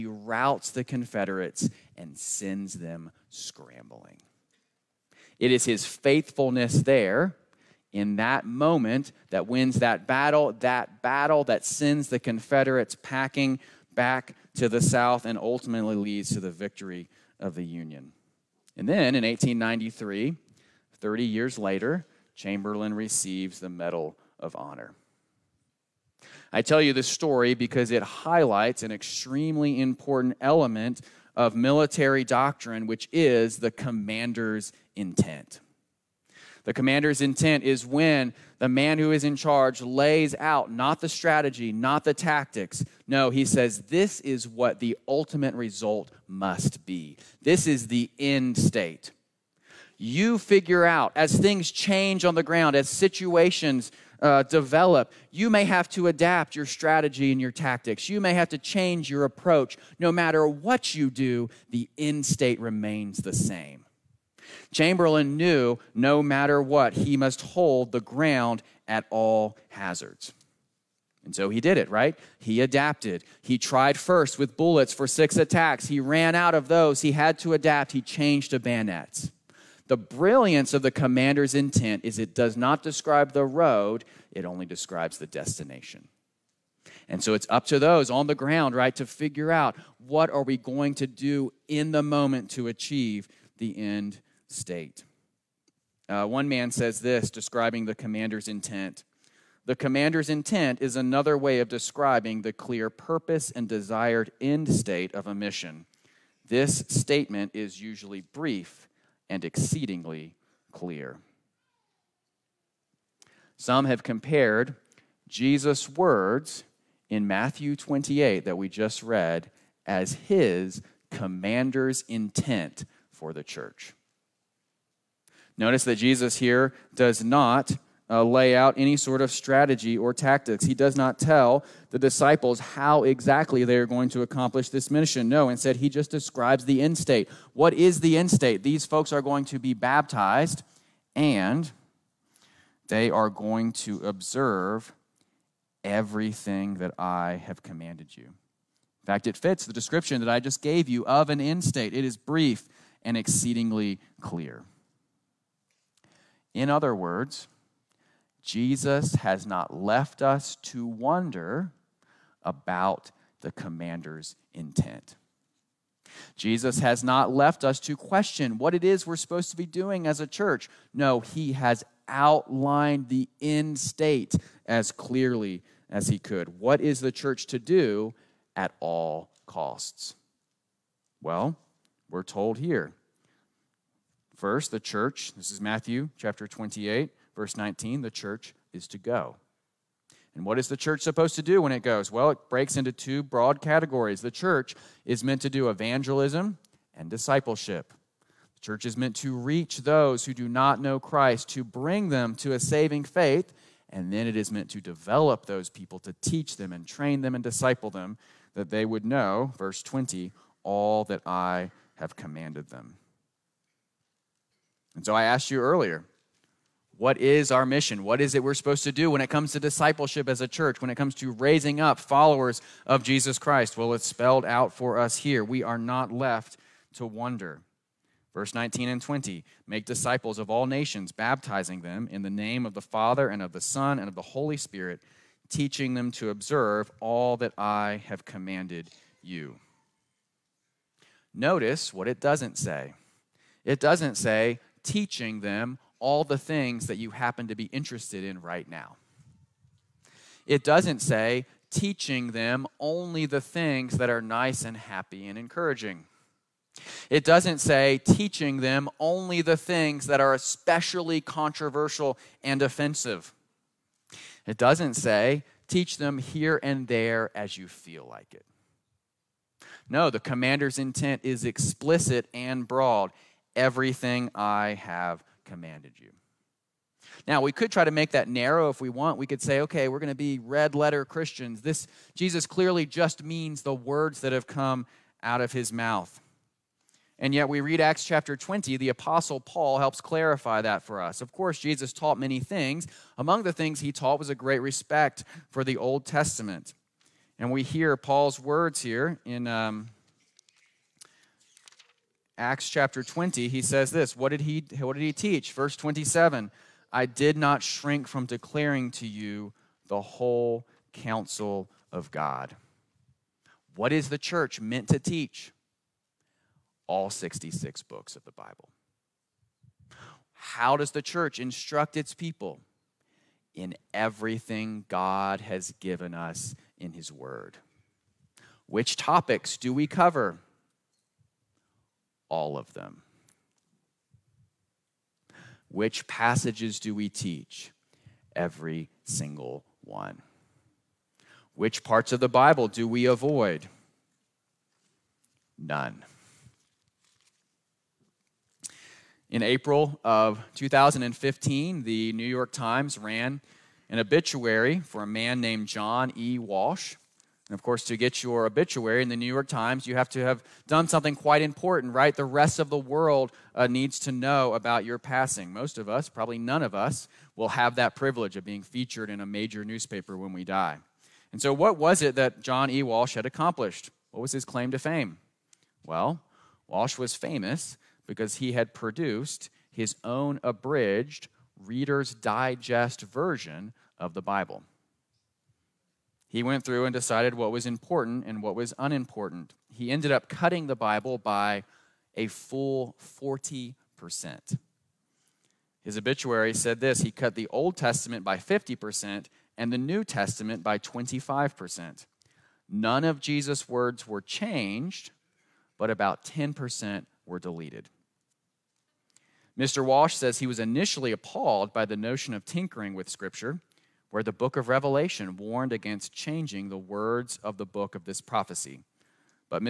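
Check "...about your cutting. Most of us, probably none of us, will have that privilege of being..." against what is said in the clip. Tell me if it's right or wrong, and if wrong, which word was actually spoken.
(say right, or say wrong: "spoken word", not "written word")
wrong: "passing", not "cutting".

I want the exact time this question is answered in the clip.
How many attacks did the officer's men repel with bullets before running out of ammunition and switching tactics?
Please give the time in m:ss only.
1:15.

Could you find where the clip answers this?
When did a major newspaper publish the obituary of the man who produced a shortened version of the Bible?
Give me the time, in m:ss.
5:49.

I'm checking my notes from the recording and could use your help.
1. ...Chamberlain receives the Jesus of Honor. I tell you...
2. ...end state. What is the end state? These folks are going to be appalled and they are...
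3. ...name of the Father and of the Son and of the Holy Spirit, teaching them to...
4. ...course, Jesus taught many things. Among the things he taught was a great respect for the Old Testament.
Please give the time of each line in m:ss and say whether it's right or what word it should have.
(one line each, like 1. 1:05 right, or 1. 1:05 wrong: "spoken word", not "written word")
1. 0:22 wrong: "Medal", not "Jesus"
2. 2:16 wrong: "baptized", not "appalled"
3. 3:52 right
4. 4:51 right.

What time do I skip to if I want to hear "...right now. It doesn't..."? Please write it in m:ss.
4:08.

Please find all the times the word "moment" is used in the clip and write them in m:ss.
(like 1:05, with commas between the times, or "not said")
0:08, 1:32.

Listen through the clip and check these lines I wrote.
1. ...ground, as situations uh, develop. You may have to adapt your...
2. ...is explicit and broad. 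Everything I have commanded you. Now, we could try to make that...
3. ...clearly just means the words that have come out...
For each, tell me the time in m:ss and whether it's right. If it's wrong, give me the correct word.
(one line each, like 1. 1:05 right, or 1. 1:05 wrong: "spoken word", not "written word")
1. 0:52 right
2. 4:31 right
3. 4:42 right.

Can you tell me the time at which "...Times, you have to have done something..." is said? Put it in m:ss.
5:59.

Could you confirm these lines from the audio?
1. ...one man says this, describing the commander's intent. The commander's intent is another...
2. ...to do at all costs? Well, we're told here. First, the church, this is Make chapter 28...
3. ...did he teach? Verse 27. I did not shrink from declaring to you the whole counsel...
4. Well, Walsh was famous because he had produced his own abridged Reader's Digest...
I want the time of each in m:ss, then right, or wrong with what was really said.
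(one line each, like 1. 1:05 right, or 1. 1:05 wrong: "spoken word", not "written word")
1. 1:36 right
2. 2:57 wrong: "Matthew", not "Make"
3. 5:04 right
4. 6:15 right.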